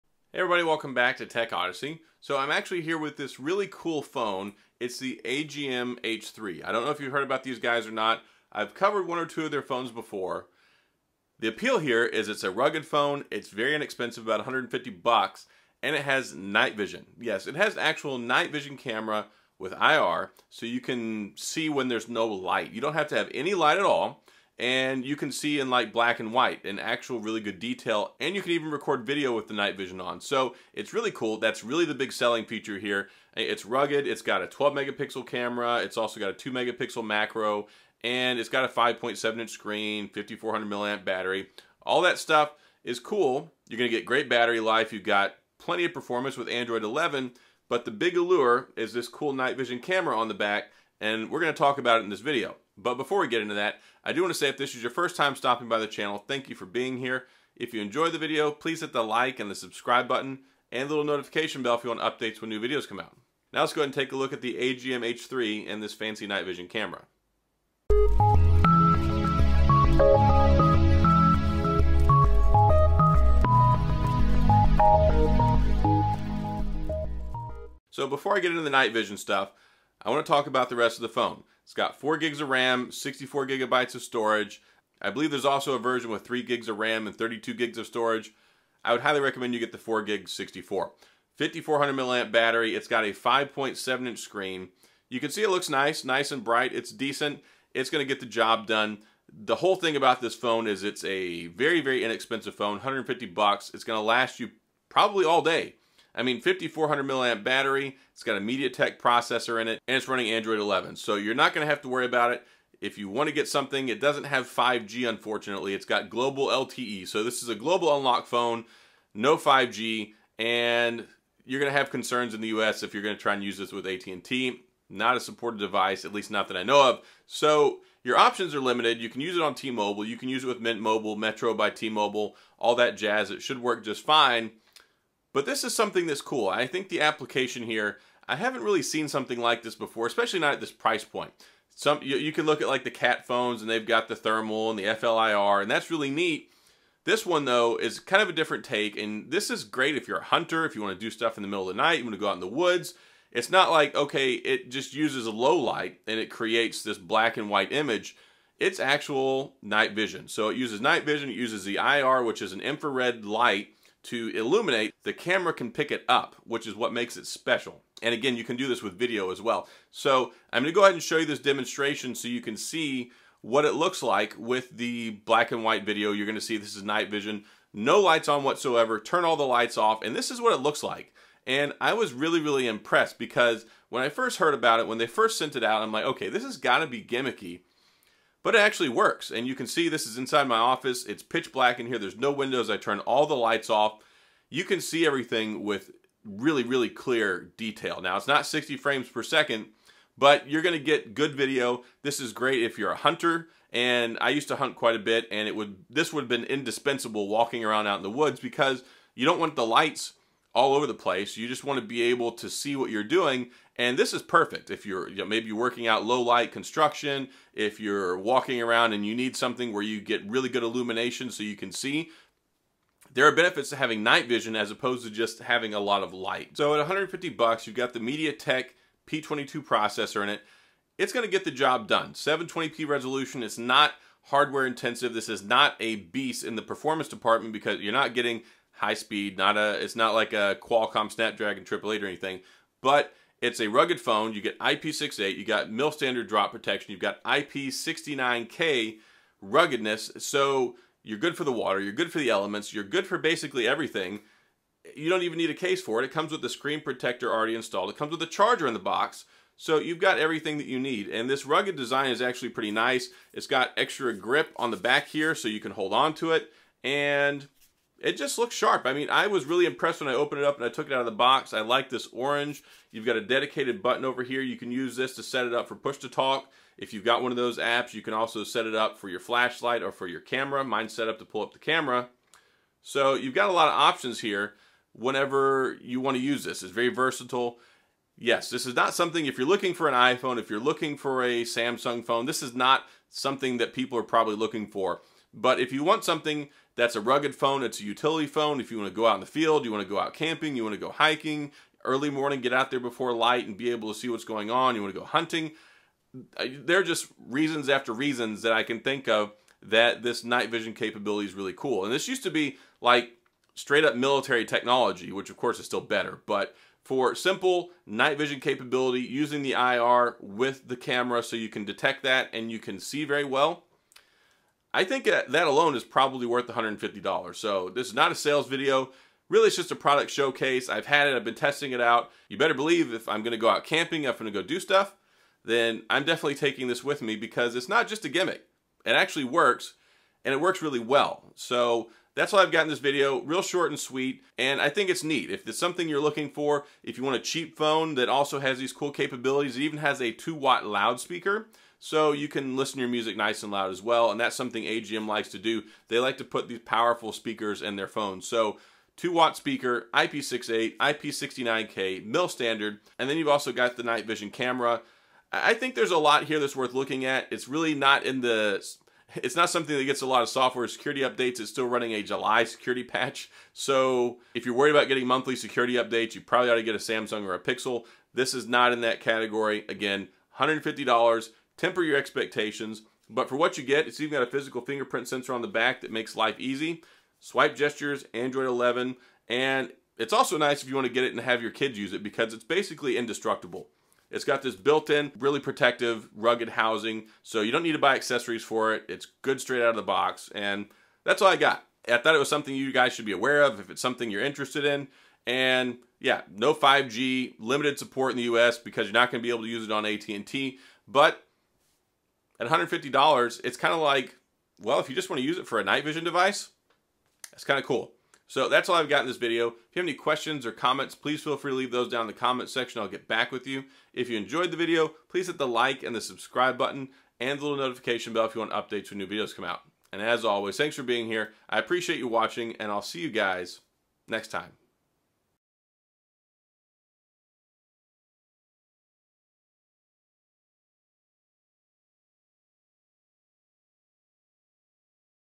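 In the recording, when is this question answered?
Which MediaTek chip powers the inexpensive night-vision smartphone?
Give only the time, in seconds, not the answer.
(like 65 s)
227 s.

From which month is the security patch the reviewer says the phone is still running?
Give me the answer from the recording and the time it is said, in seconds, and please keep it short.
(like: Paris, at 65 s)
July, at 372 s.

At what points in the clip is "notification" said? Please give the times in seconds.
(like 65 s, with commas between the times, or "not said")
61 s, 427 s.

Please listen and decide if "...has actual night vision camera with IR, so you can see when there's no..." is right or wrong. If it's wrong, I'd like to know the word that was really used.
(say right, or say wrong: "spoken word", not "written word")
right.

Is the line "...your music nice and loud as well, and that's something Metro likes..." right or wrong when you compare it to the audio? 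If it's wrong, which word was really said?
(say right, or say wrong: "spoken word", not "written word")
wrong: "AGM", not "Metro".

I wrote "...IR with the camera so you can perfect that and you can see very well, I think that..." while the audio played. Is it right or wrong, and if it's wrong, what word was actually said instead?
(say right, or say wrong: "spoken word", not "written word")
wrong: "detect", not "perfect".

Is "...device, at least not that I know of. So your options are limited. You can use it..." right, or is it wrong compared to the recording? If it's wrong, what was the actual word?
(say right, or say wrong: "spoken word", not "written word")
right.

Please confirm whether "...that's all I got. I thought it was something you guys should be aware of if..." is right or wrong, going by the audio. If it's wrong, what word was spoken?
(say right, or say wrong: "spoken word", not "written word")
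right.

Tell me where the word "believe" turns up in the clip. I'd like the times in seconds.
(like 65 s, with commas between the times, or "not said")
85 s, 332 s.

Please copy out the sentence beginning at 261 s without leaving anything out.
And this rugged design is actually pretty nice.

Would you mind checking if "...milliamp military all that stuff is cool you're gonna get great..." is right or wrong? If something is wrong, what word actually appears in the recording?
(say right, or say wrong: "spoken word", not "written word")
wrong: "battery", not "military".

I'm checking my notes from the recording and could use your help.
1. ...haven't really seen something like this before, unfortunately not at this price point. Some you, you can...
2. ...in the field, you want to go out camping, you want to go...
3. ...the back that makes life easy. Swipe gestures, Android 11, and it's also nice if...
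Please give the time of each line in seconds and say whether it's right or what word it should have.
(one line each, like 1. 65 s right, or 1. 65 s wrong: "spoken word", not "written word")
1. 138 s wrong: "especially", not "unfortunately"
2. 299 s right
3. 385 s right.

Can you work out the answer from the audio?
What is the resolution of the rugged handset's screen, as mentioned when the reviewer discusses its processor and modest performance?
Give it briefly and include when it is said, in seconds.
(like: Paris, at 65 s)
720p, at 232 s.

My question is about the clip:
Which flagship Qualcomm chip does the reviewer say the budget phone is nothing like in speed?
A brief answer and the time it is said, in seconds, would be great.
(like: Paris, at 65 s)
Snapdragon 888, at 241 s.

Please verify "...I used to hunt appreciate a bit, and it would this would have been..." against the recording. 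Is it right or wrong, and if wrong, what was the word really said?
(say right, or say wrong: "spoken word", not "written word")
wrong: "quite", not "appreciate".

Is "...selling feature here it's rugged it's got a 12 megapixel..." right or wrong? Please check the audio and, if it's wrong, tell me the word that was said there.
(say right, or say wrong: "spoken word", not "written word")
right.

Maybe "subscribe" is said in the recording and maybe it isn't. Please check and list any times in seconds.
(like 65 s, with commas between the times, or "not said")
59 s, 425 s.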